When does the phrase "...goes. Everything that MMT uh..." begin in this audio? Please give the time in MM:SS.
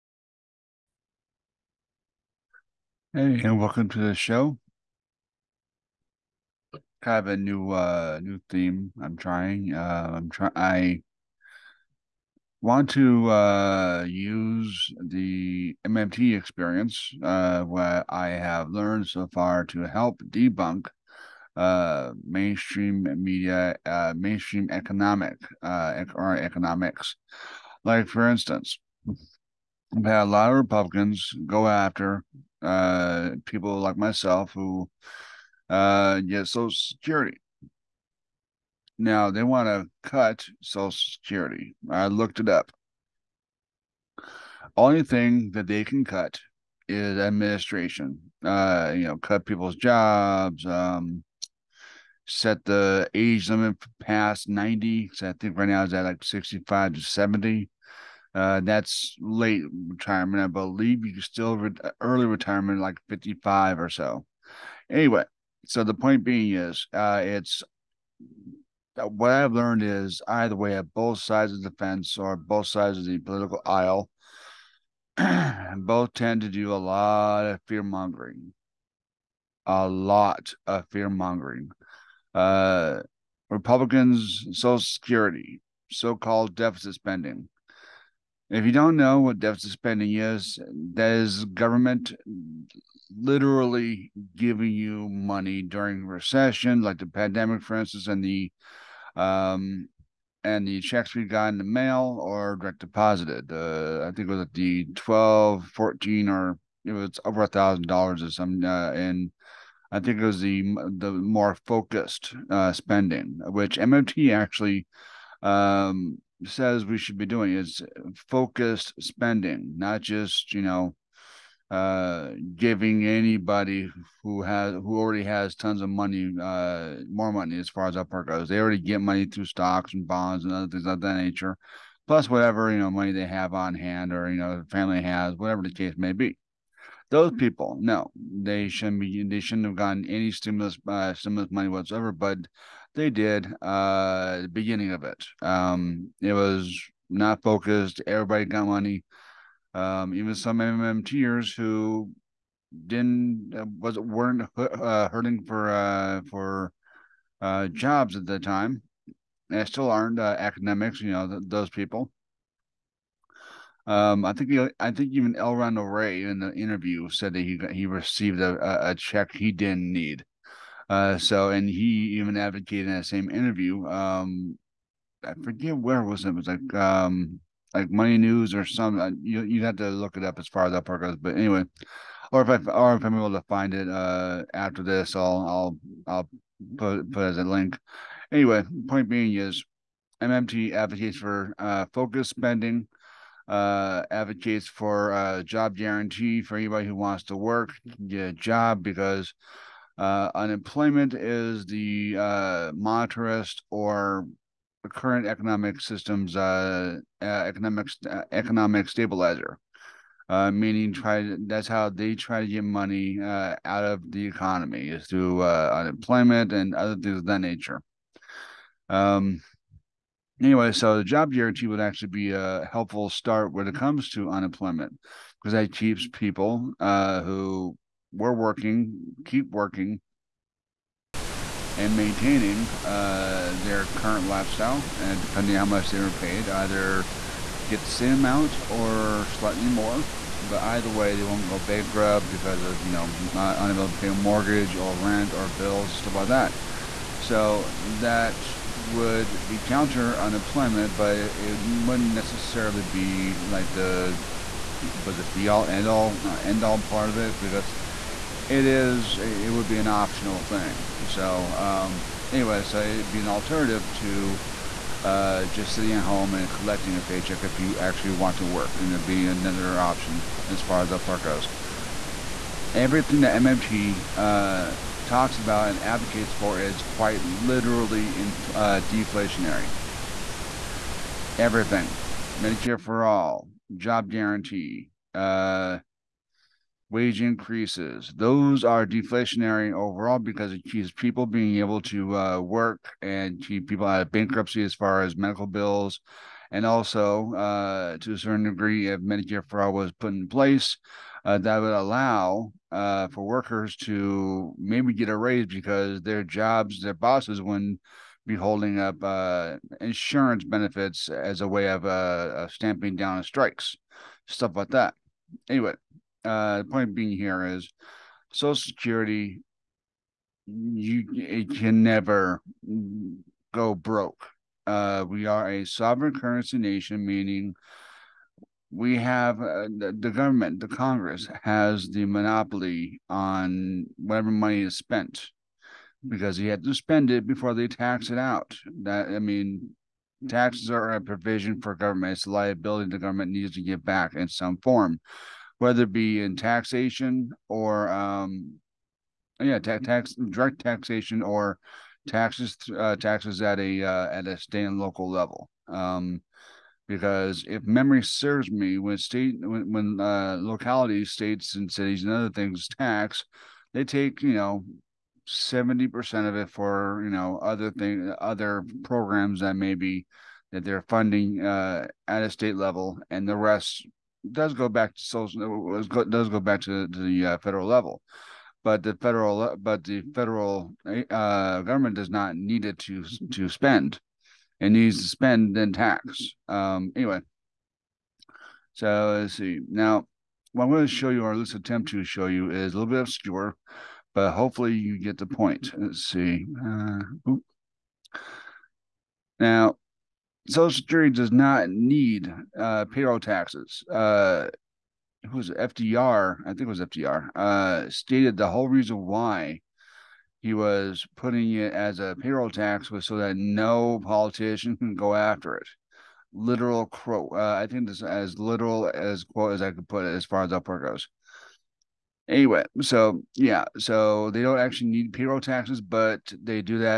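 04:31.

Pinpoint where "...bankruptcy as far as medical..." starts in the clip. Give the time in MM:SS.
04:54.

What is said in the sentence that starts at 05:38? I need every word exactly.
That I mean, taxes are a provision for government.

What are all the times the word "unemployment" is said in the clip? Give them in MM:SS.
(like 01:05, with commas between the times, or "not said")
03:20, 03:35, 03:44, 04:10.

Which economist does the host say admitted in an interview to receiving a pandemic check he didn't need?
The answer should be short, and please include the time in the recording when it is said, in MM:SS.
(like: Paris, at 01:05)
Elron Ray, at 02:45.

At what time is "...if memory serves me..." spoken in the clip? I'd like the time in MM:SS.
05:57.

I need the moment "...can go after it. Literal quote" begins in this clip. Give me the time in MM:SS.
06:54.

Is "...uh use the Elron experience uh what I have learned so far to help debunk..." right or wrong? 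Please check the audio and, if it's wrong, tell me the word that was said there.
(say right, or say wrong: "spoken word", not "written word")
wrong: "MMT", not "Elron".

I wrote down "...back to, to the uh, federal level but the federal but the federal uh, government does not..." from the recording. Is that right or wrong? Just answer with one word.
right.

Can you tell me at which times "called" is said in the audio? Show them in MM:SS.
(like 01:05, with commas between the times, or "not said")
01:26.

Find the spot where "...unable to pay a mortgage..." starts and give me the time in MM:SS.
04:03.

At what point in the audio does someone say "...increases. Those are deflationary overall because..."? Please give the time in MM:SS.
04:47.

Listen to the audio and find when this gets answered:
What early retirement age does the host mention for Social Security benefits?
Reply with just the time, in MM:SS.
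01:03.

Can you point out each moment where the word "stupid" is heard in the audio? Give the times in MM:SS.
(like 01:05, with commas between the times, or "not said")
not said.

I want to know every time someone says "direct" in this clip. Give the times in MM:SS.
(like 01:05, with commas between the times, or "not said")
01:42, 05:50.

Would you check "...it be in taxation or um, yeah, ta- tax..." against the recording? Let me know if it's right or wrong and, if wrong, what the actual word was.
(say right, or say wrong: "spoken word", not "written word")
right.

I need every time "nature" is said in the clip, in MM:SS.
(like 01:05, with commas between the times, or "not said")
02:11, 03:37.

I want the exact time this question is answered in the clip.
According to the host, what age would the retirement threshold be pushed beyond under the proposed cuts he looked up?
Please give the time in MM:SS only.
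00:54.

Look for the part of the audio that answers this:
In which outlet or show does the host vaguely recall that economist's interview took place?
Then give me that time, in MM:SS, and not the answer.
02:57.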